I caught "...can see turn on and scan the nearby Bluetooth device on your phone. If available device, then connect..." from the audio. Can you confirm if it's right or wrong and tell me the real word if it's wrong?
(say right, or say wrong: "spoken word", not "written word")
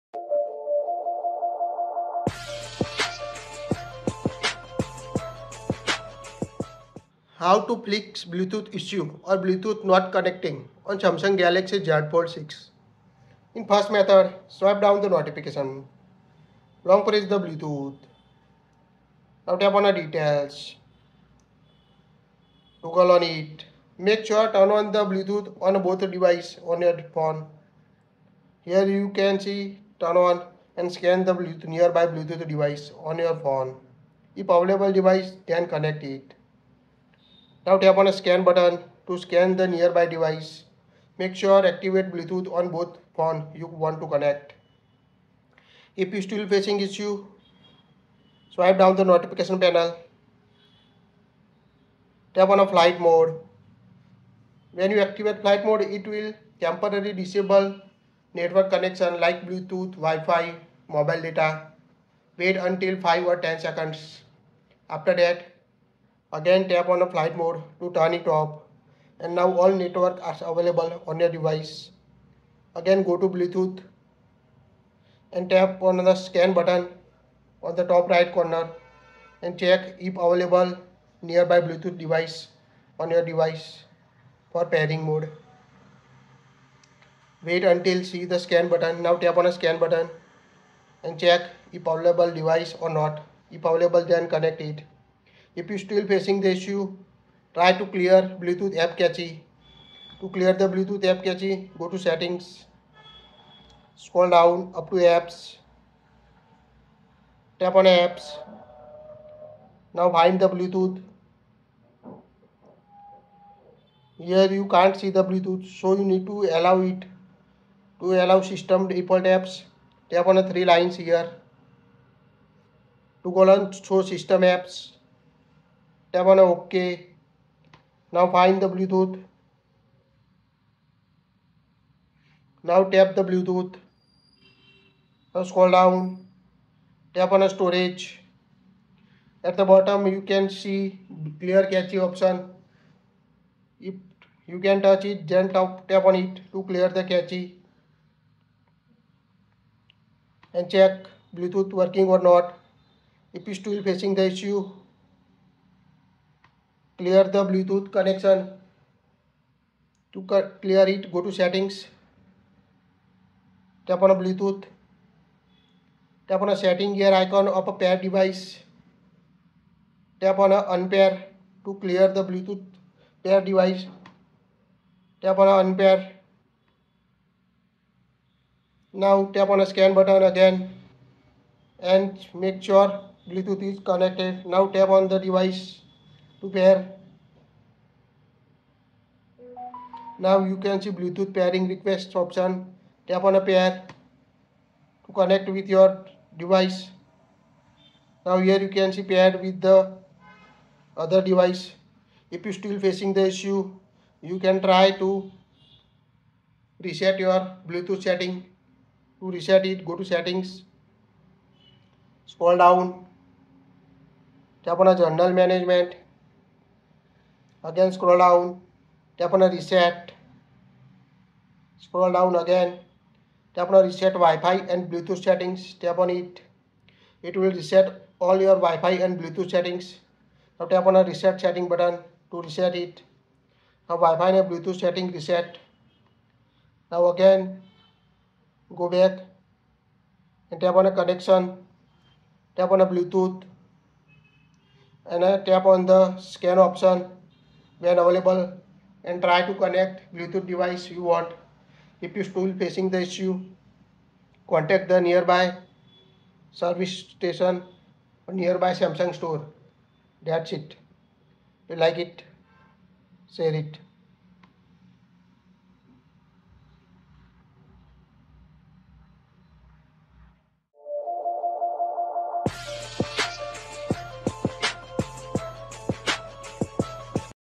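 right.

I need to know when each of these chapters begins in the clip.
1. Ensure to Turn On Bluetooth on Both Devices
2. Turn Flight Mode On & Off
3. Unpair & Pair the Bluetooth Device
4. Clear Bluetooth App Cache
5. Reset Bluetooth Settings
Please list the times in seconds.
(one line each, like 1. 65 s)
1. 13 s
2. 48 s
3. 155 s
4. 97 s
5. 205 s.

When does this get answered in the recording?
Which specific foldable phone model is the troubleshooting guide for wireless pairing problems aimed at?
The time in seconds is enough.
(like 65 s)
10 s.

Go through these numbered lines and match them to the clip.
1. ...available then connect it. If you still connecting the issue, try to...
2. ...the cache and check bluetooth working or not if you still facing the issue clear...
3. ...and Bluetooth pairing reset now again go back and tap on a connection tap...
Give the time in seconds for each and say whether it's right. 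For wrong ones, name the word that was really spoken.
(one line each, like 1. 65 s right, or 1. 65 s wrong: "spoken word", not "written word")
1. 93 s wrong: "facing", not "connecting"
2. 146 s right
3. 234 s wrong: "setting", not "pairing".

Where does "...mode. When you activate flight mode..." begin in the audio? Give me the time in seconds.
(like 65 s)
52 s.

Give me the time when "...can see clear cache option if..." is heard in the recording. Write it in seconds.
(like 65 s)
140 s.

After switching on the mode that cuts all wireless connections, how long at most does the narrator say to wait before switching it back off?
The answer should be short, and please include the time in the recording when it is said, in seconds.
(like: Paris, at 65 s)
10 seconds, at 63 s.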